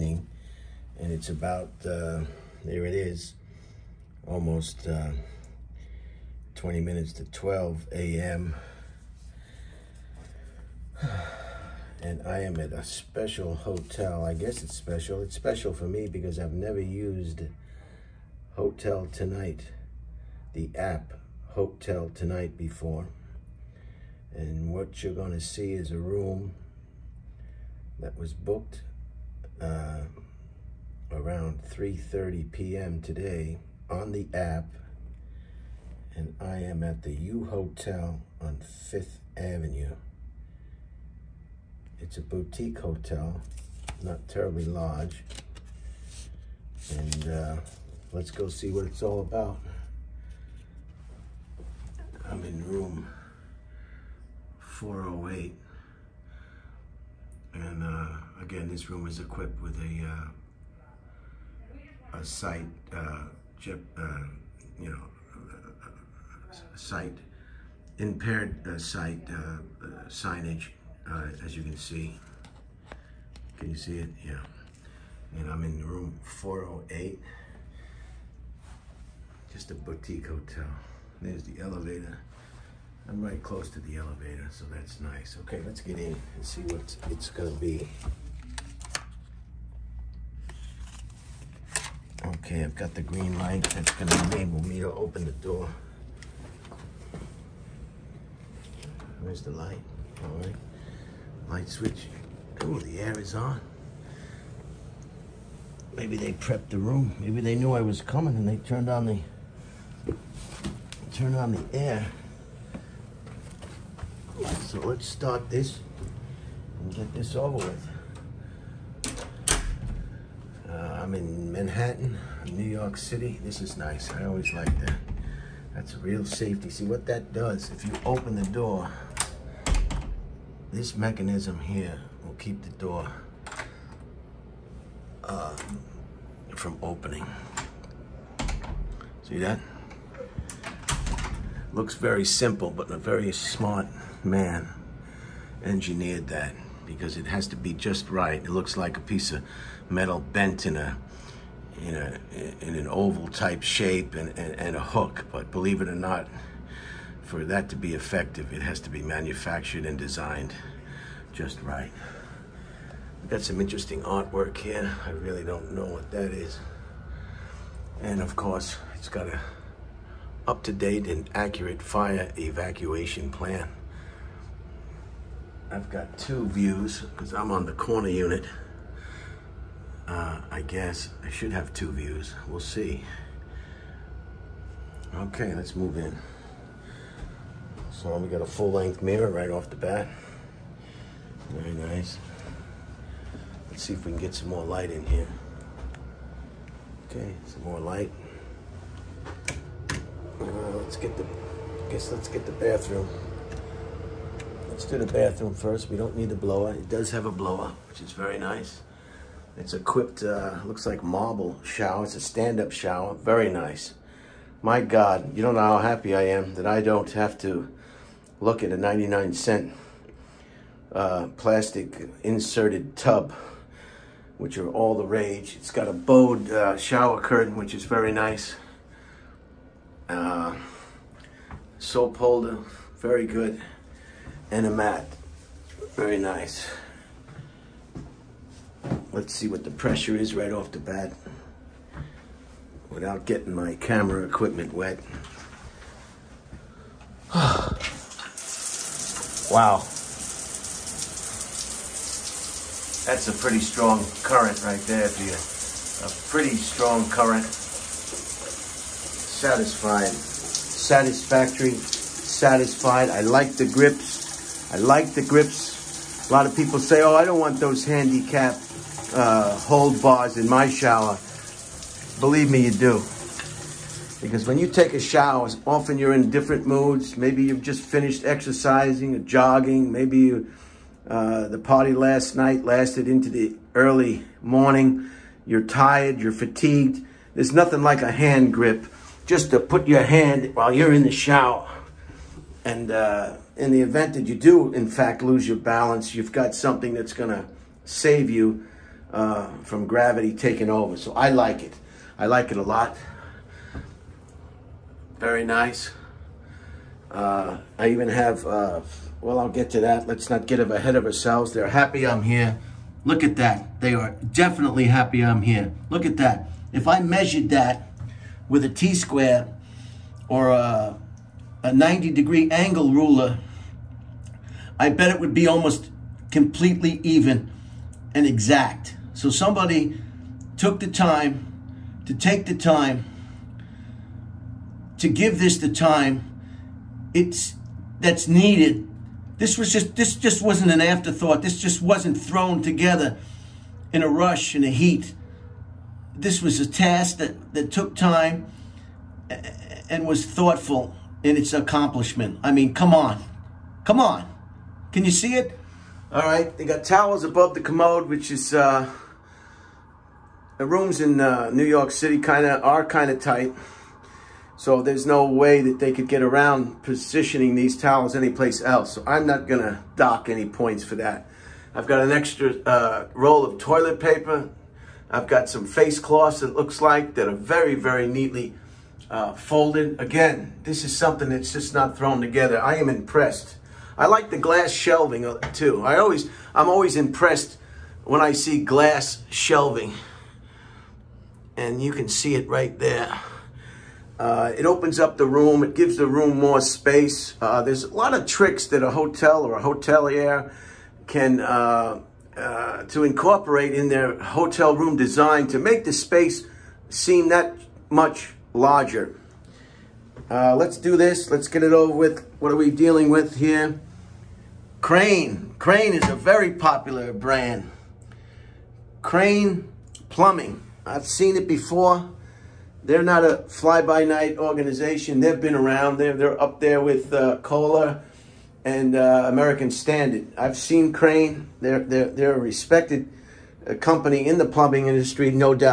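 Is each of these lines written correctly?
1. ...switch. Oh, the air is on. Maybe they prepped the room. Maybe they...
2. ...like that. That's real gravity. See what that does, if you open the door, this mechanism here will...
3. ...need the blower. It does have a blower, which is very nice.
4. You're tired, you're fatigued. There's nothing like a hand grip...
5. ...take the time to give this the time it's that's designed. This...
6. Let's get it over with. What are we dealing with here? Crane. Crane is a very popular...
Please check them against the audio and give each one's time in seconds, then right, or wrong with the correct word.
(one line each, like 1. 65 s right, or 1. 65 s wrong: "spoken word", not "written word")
1. 101 s right
2. 124 s wrong: "safety", not "gravity"
3. 206 s right
4. 285 s right
5. 332 s wrong: "needed", not "designed"
6. 411 s right.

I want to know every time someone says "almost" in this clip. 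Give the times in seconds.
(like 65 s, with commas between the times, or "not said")
4 s, 325 s.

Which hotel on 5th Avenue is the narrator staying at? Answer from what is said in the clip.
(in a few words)
U Hotel.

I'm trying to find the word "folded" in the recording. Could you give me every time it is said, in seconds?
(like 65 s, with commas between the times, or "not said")
379 s.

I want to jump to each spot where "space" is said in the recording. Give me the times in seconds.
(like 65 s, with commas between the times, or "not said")
396 s, 405 s.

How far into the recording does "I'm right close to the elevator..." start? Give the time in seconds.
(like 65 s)
83 s.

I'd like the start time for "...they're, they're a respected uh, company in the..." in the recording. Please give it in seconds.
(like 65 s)
431 s.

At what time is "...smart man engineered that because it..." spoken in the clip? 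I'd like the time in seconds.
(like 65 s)
143 s.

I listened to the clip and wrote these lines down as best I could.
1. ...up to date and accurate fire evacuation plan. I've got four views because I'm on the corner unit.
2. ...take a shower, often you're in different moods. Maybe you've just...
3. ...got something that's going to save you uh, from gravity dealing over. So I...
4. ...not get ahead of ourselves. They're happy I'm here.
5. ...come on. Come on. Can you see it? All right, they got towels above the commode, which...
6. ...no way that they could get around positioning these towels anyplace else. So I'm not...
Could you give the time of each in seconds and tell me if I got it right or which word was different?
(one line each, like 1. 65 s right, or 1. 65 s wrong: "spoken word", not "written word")
1. 170 s wrong: "two", not "four"
2. 274 s right
3. 296 s wrong: "taking", not "dealing"
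4. 310 s right
5. 352 s right
6. 365 s right.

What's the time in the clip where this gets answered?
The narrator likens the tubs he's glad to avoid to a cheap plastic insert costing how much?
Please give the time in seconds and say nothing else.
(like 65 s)
218 s.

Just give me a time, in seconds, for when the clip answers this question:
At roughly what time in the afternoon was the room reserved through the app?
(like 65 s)
31 s.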